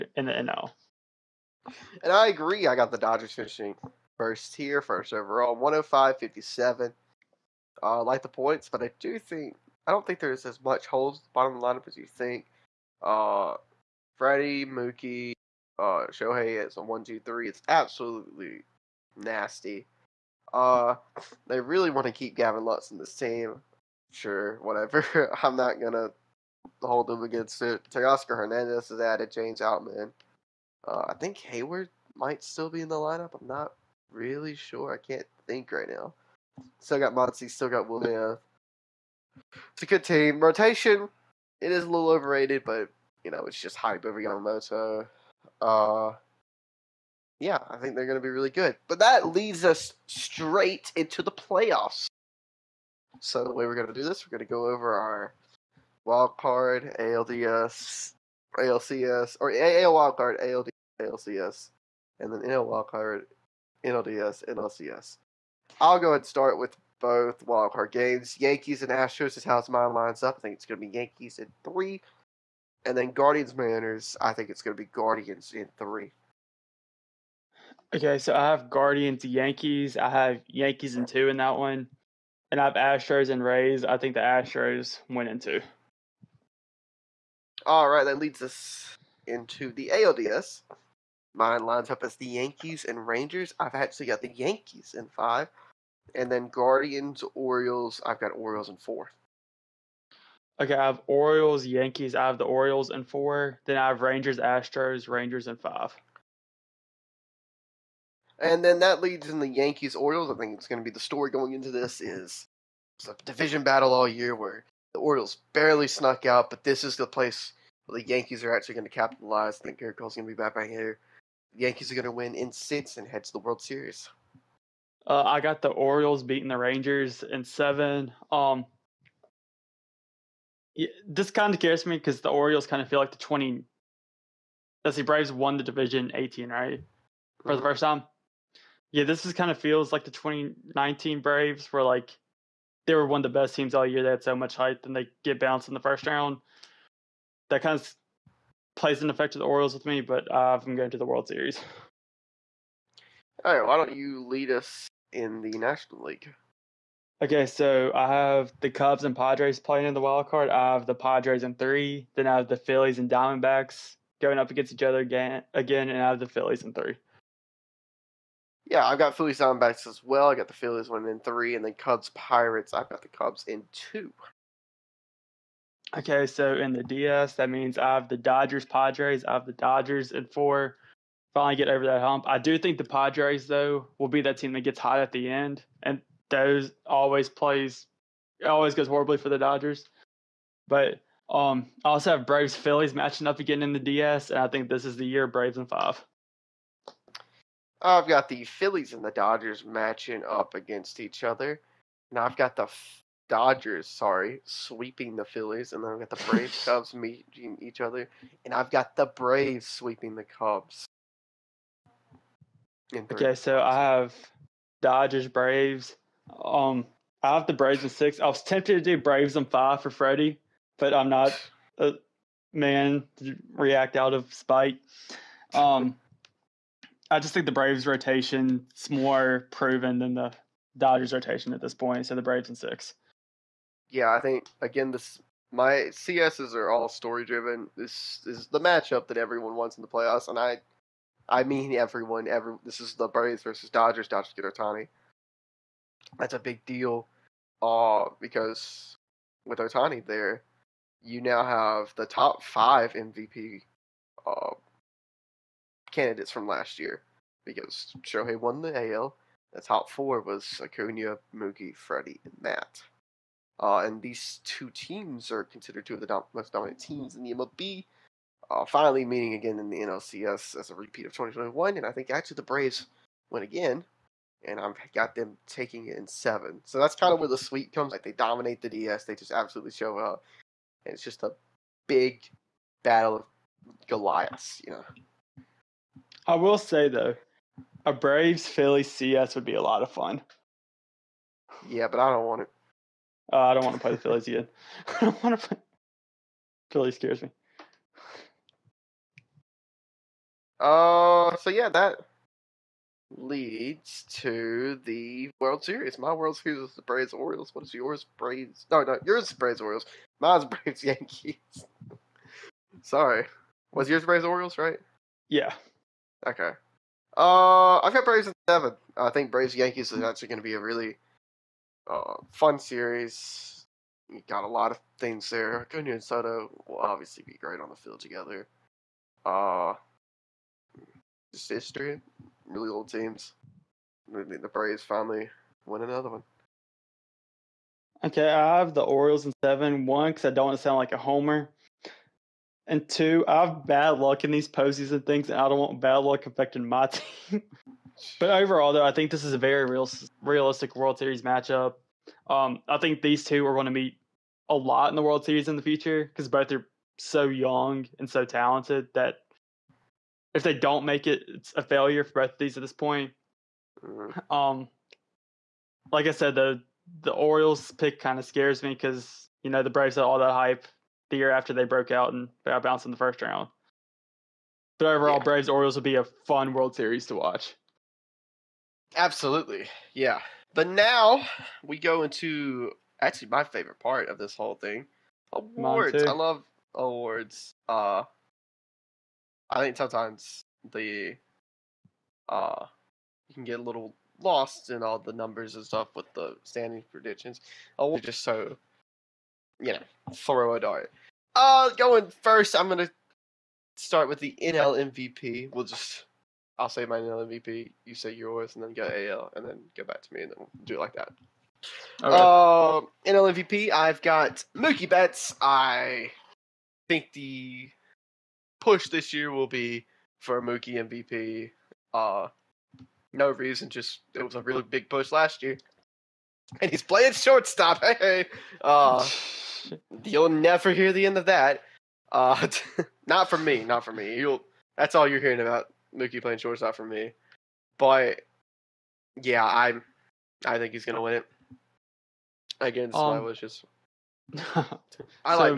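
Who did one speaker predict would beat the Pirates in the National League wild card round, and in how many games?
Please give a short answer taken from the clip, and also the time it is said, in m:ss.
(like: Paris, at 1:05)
Cubs in 2, at 2:53.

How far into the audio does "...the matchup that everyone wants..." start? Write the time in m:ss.
3:58.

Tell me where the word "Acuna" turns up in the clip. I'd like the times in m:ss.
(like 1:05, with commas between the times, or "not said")
4:20, 5:25.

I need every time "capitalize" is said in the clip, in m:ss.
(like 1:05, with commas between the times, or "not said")
1:58.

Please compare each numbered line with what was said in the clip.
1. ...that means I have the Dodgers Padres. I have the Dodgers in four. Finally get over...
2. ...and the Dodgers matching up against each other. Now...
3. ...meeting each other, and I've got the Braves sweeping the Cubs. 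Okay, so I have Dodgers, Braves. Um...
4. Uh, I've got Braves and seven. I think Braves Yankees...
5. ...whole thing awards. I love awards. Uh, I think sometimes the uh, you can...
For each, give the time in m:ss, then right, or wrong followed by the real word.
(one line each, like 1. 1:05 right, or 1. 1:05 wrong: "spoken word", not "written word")
1. 2:57 right
2. 3:18 right
3. 3:26 right
4. 5:17 right
5. 6:24 right.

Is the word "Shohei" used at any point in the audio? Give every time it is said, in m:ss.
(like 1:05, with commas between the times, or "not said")
0:16, 4:18.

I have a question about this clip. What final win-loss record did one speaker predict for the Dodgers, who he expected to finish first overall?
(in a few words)
105-57.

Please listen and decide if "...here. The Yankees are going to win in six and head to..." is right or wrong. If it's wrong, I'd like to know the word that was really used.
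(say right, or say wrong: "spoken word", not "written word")
right.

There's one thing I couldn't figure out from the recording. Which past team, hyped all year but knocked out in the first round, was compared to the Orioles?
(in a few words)
2019 Braves.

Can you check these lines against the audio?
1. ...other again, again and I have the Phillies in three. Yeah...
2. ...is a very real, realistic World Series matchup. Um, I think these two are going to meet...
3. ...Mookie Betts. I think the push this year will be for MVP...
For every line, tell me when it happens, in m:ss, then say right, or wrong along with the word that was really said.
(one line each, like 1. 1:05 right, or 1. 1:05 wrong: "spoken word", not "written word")
1. 2:44 right
2. 5:49 right
3. 6:54 wrong: "Mookie", not "MVP".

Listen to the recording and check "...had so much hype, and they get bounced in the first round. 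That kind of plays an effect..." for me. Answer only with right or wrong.
right.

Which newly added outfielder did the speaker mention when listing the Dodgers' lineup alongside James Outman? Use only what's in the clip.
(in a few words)
Teoscar Hernandez.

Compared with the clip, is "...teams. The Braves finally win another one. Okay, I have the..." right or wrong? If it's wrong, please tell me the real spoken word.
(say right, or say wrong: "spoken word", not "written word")
right.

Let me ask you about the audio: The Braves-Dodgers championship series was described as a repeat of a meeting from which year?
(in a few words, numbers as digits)
2021.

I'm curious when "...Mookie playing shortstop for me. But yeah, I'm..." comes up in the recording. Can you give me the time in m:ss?
7:15.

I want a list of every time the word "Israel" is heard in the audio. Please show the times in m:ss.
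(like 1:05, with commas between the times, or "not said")
not said.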